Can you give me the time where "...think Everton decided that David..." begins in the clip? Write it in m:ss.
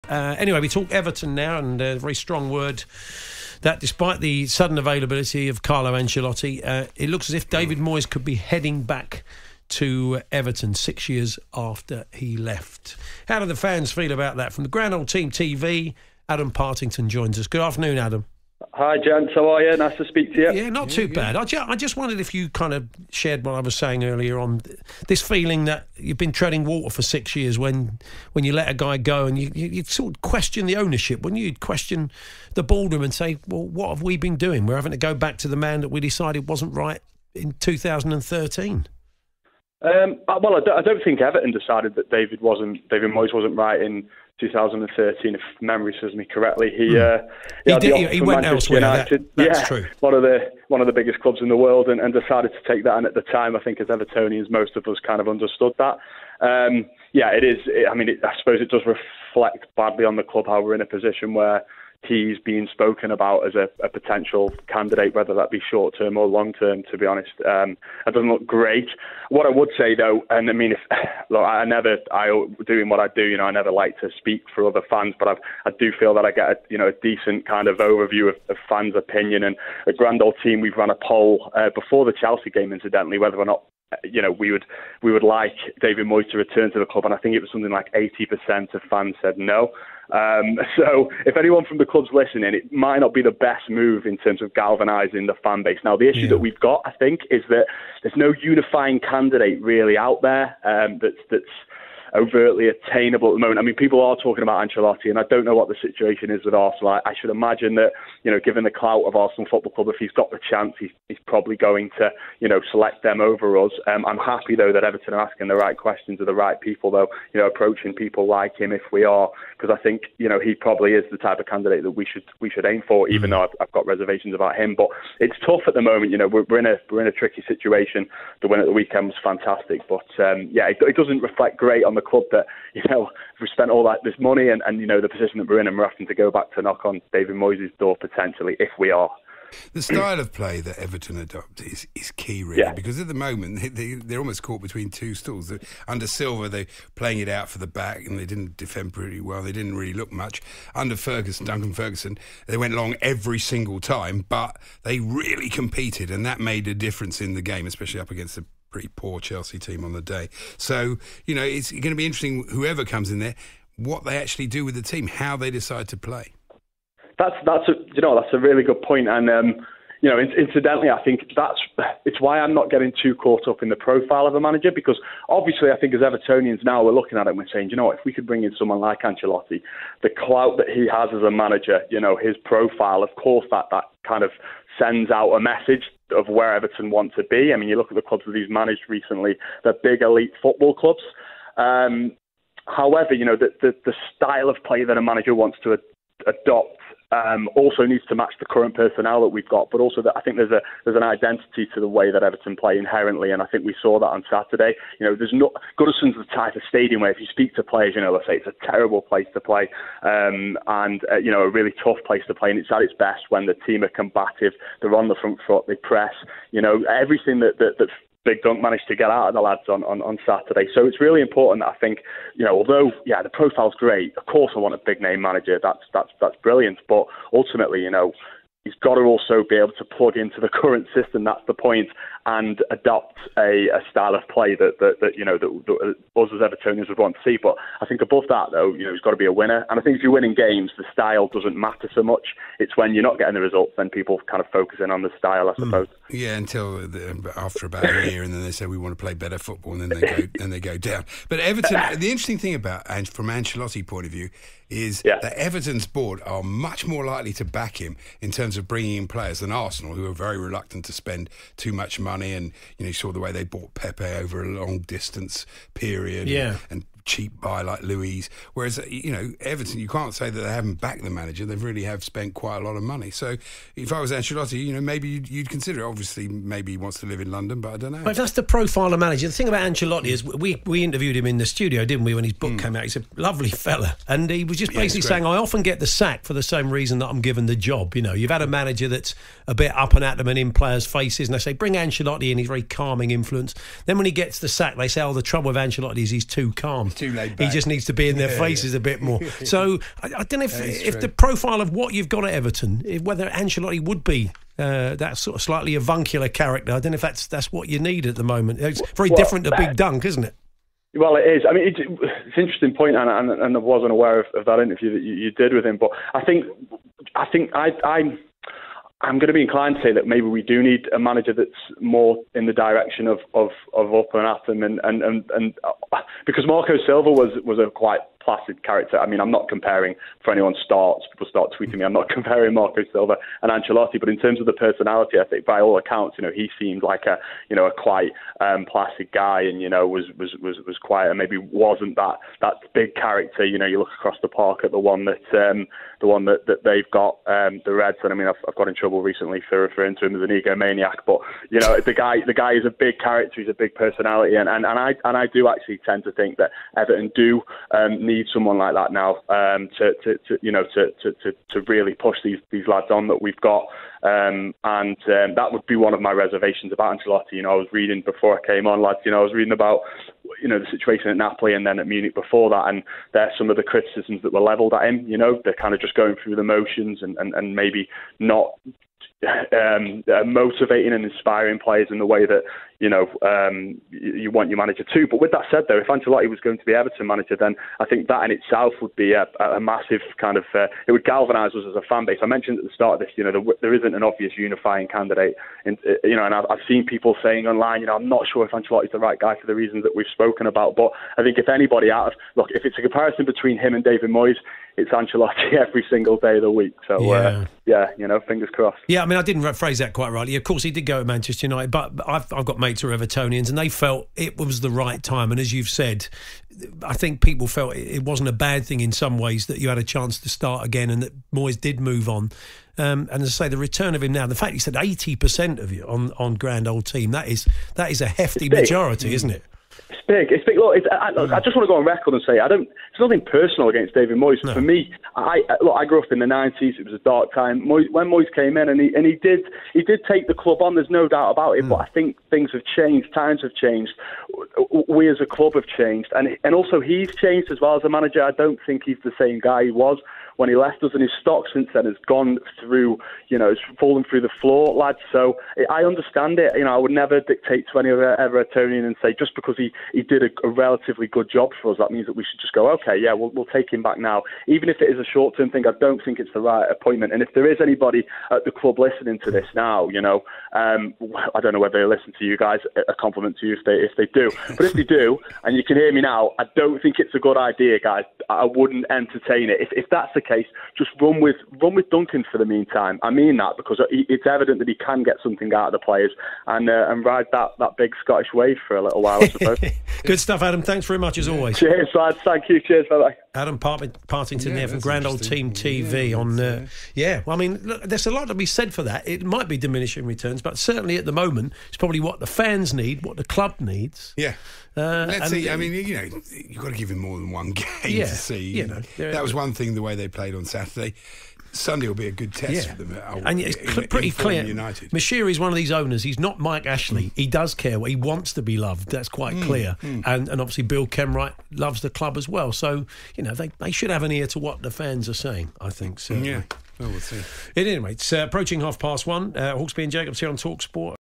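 0:41.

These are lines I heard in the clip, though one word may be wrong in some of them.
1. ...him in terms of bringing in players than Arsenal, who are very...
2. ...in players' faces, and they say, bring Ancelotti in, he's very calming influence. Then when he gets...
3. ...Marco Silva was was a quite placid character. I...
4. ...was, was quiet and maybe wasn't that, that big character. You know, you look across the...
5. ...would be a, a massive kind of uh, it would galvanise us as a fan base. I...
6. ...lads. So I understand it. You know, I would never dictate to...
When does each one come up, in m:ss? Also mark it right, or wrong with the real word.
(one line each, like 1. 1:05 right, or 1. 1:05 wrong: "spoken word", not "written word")
1. 4:17 right
2. 4:50 right
3. 5:26 right
4. 5:40 right
5. 6:28 right
6. 7:34 right.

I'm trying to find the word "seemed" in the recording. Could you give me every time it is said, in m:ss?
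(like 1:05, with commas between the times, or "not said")
5:36.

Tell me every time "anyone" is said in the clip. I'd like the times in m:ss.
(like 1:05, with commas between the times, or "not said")
1:31, 5:30.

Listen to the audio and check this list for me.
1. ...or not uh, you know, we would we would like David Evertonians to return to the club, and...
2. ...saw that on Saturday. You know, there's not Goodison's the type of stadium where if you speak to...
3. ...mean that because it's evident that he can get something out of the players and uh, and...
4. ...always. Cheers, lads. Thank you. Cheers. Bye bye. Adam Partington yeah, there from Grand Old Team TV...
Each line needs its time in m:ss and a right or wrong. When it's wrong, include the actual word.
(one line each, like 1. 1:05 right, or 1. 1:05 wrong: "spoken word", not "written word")
1. 1:23 wrong: "Moyes", not "Evertonians"
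2. 3:23 right
3. 8:03 right
4. 8:11 right.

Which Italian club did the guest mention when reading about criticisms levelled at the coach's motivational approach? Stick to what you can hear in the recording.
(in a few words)
Napoli.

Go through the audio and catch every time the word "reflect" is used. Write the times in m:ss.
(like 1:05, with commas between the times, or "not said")
0:58, 2:11.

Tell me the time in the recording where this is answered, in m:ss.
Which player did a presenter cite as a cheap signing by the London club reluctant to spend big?
4:27.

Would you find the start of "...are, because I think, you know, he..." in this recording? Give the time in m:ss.
1:59.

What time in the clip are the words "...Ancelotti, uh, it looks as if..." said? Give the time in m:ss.
0:05.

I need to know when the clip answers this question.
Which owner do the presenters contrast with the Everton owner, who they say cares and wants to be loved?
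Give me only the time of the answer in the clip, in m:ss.
8:36.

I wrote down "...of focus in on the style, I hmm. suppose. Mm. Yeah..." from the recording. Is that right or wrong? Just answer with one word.
right.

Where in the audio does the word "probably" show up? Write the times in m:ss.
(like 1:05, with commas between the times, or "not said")
1:51, 2:00, 8:21.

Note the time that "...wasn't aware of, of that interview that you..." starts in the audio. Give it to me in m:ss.
5:13.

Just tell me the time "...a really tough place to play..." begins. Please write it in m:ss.
3:31.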